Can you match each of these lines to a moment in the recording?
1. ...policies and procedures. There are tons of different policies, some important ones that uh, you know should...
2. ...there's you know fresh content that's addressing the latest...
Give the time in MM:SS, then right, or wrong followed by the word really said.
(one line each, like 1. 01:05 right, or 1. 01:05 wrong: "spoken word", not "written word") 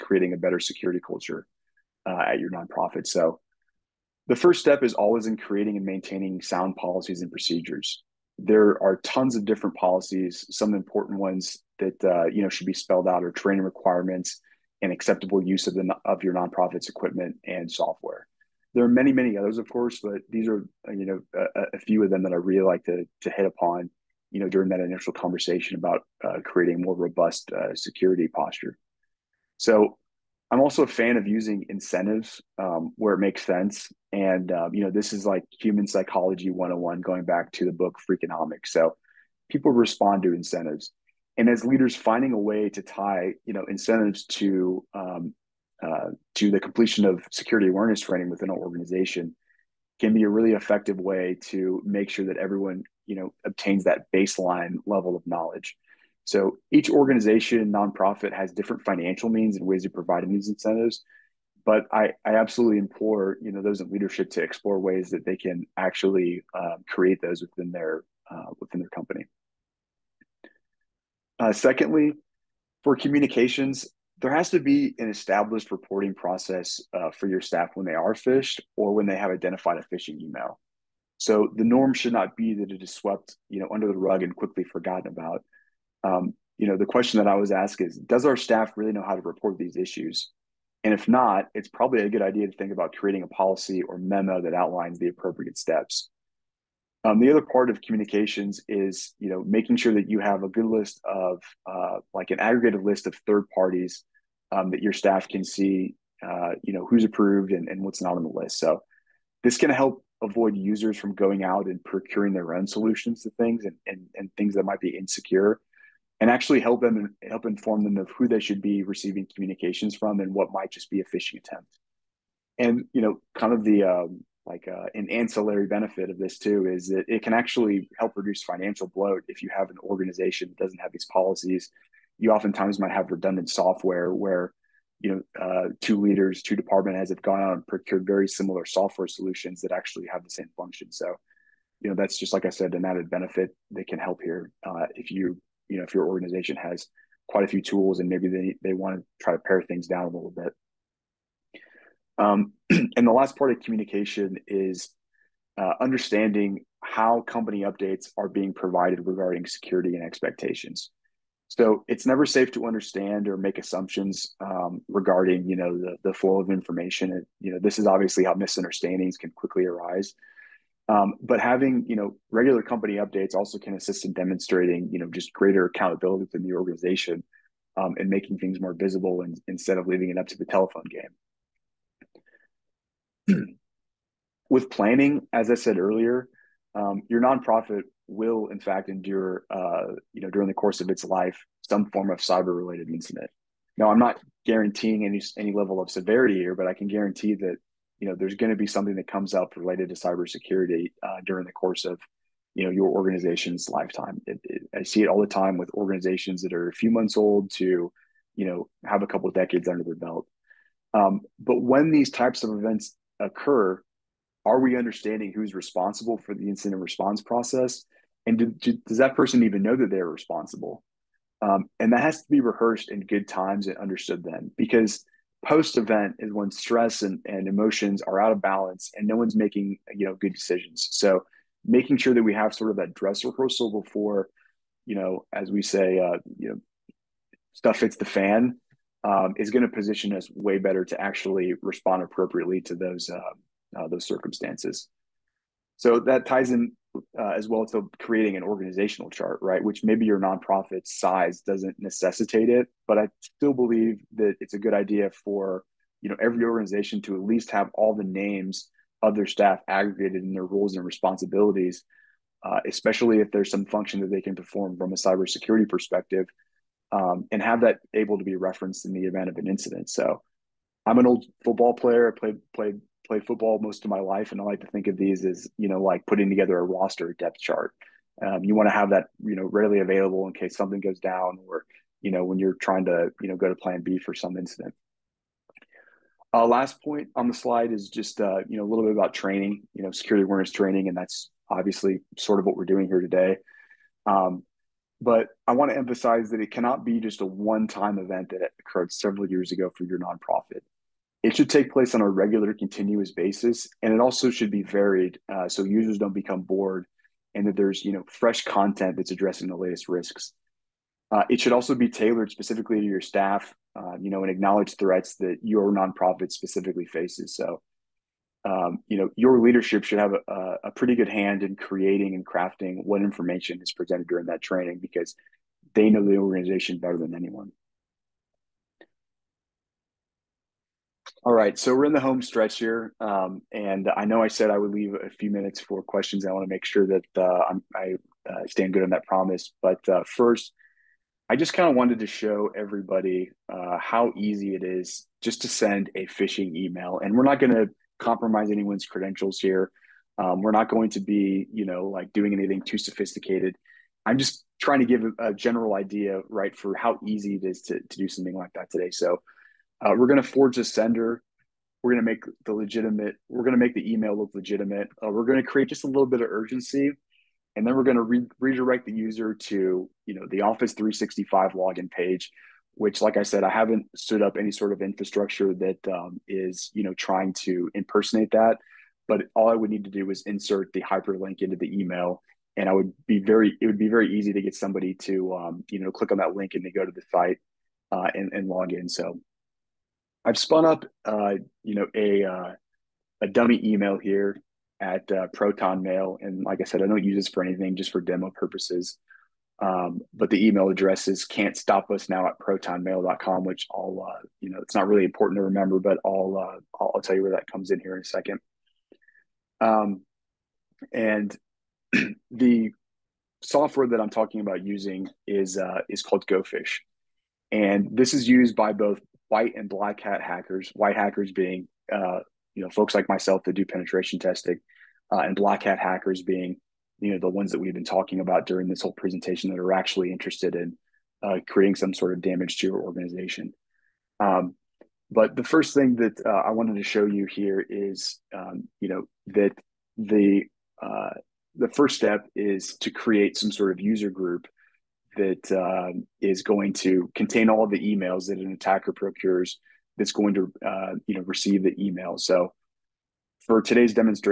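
1. 00:06 right
2. 05:07 right.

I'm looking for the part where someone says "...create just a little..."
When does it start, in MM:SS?
06:05.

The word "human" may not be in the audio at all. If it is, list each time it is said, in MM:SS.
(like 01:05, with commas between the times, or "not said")
00:35.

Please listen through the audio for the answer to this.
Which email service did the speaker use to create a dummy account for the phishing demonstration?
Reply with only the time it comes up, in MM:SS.
06:35.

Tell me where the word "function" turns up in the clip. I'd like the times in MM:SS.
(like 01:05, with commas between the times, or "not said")
02:20, 04:23.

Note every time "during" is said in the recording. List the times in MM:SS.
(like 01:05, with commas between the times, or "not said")
00:24, 03:10, 03:21, 05:24, 07:08.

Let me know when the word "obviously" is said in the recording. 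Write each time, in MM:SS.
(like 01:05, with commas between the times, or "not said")
02:47, 04:51.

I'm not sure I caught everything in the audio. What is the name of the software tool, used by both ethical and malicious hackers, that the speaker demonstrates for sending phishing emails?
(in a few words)
GoFish.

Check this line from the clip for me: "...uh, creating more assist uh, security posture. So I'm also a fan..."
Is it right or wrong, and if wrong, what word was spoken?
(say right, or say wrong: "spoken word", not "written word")
wrong: "robust", not "assist".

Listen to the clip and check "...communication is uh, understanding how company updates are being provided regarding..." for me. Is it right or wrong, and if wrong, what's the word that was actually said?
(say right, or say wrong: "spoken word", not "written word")
right.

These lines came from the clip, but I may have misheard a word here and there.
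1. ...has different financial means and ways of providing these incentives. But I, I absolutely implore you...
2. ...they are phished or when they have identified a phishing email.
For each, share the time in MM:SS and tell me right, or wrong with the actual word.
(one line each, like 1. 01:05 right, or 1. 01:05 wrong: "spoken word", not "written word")
1. 00:58 right
2. 01:17 right.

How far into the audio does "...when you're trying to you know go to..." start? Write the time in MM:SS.
04:42.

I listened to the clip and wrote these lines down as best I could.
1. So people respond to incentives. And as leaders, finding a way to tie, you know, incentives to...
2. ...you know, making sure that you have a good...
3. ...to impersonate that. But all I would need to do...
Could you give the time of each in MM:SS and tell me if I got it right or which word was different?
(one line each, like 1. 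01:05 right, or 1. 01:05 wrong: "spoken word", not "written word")
1. 00:38 right
2. 01:39 right
3. 06:17 right.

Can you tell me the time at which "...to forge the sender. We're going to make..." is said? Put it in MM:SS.
06:00.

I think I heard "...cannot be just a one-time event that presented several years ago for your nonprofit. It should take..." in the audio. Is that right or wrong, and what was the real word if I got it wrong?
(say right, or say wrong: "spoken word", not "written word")
wrong: "occurred", not "presented".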